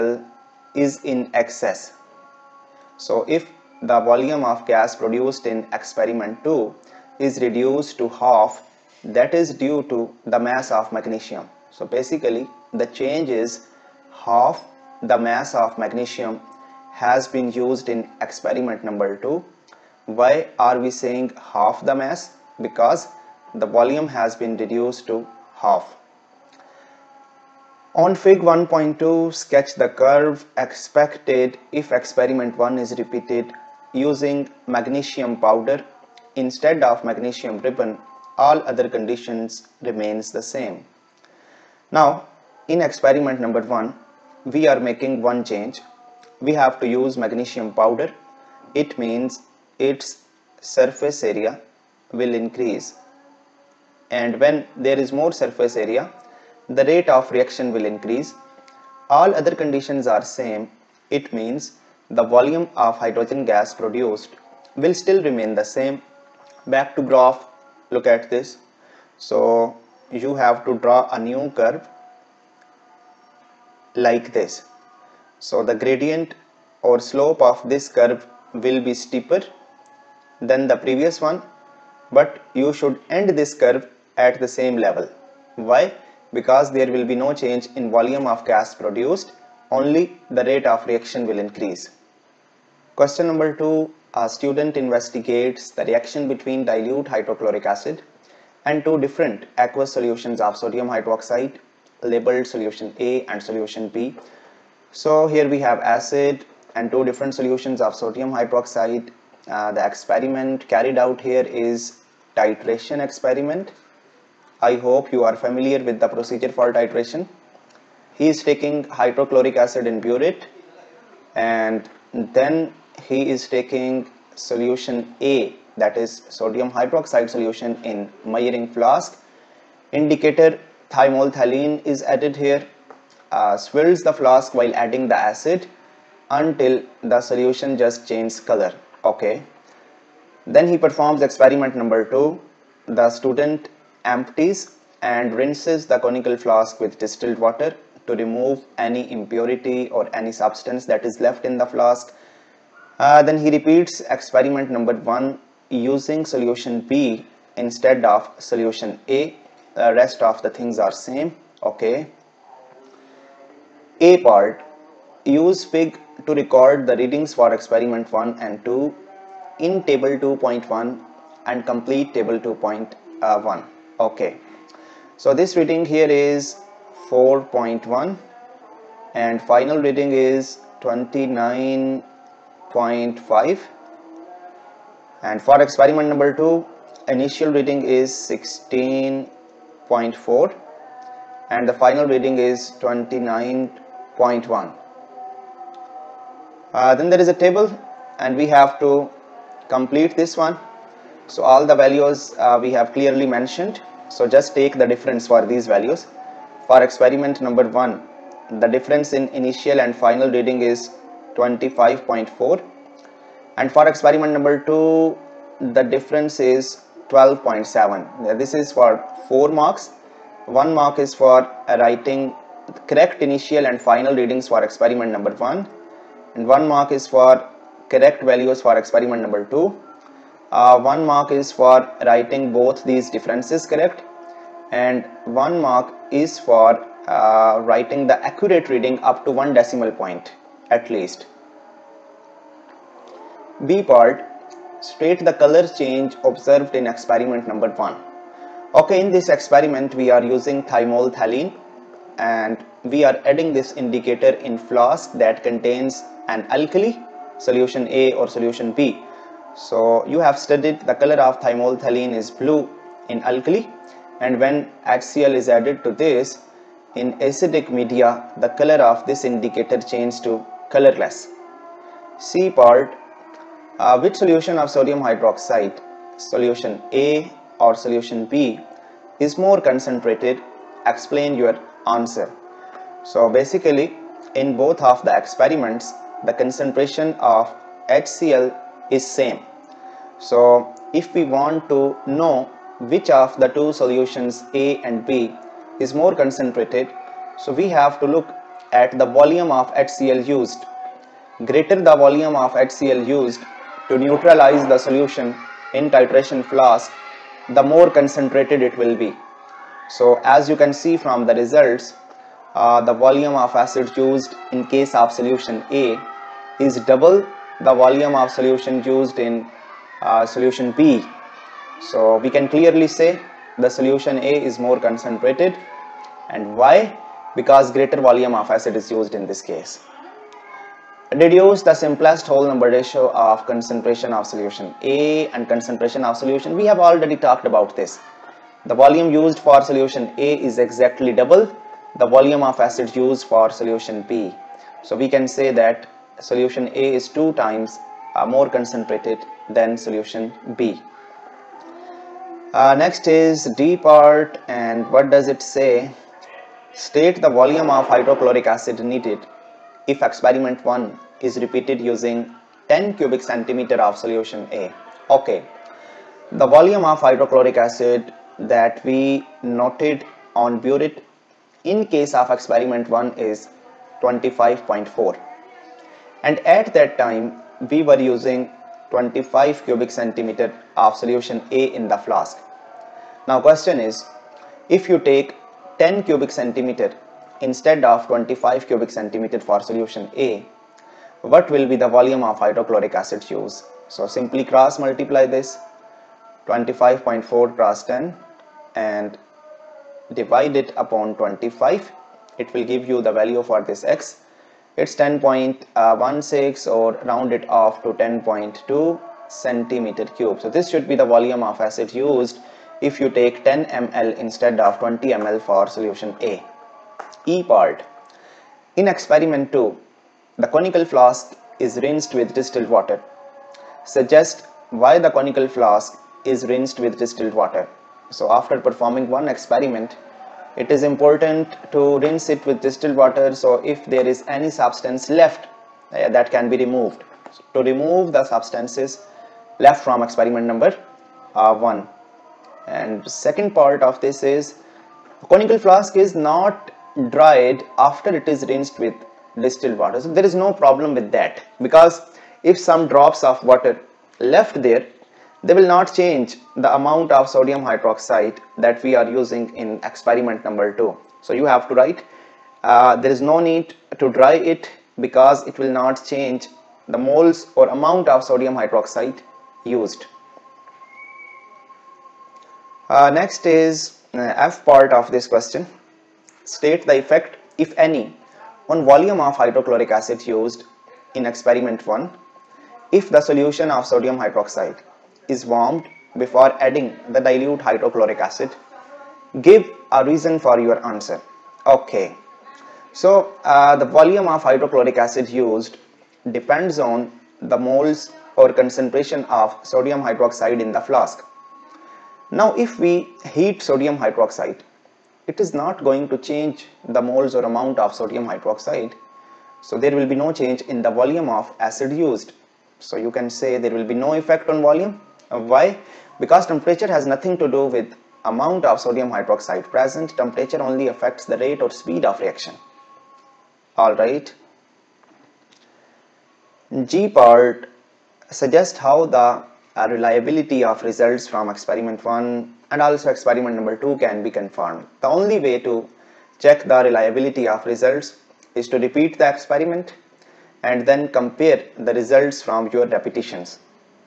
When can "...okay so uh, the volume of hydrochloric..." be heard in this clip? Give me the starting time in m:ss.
8:11.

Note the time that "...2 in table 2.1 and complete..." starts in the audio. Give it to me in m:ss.
2:48.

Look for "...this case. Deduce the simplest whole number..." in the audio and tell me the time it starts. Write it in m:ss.
5:29.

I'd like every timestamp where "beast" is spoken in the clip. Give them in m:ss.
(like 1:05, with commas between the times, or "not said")
not said.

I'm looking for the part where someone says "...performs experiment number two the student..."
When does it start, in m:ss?
2:20.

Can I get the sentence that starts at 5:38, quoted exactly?
The volume used for solution A is exactly double the volume of acid used for solution B.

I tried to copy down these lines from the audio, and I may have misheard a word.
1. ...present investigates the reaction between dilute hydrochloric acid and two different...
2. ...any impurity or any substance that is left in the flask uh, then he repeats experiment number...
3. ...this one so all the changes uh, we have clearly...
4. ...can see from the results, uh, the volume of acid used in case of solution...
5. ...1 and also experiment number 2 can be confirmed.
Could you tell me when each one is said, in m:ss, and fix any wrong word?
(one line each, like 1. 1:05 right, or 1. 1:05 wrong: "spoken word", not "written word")
1. 1:34 wrong: "student", not "present"
2. 2:28 right
3. 3:20 wrong: "values", not "changes"
4. 5:10 right
5. 8:52 right.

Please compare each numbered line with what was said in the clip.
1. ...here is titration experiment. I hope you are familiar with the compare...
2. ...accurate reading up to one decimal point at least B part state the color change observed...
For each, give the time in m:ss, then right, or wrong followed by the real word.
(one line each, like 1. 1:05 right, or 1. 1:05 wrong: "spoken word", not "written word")
1. 1:51 wrong: "procedure", not "compare"
2. 3:58 right.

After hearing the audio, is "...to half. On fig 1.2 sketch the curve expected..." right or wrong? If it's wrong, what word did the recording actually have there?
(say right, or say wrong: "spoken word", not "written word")
right.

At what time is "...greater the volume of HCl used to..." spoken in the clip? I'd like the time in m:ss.
5:01.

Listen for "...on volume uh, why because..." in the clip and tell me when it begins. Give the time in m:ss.
8:34.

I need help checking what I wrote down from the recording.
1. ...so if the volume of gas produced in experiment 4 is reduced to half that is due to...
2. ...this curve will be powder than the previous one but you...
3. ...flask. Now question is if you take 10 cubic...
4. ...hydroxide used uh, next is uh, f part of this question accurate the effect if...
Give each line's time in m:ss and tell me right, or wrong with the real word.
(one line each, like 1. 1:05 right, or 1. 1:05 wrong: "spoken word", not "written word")
1. 0:02 wrong: "2", not "4"
2. 1:17 wrong: "steeper", not "powder"
3. 6:21 right
4. 7:48 wrong: "state", not "accurate".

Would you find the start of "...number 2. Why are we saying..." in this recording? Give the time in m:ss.
0:18.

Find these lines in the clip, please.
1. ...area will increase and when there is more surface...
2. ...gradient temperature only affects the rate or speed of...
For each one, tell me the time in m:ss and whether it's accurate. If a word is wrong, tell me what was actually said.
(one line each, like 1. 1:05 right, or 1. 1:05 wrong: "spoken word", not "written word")
1. 0:51 right
2. 8:39 wrong: "present", not "gradient".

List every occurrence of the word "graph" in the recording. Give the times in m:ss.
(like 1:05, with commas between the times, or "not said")
1:07.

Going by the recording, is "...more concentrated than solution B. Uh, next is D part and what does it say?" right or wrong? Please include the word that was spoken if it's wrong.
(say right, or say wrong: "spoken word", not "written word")
right.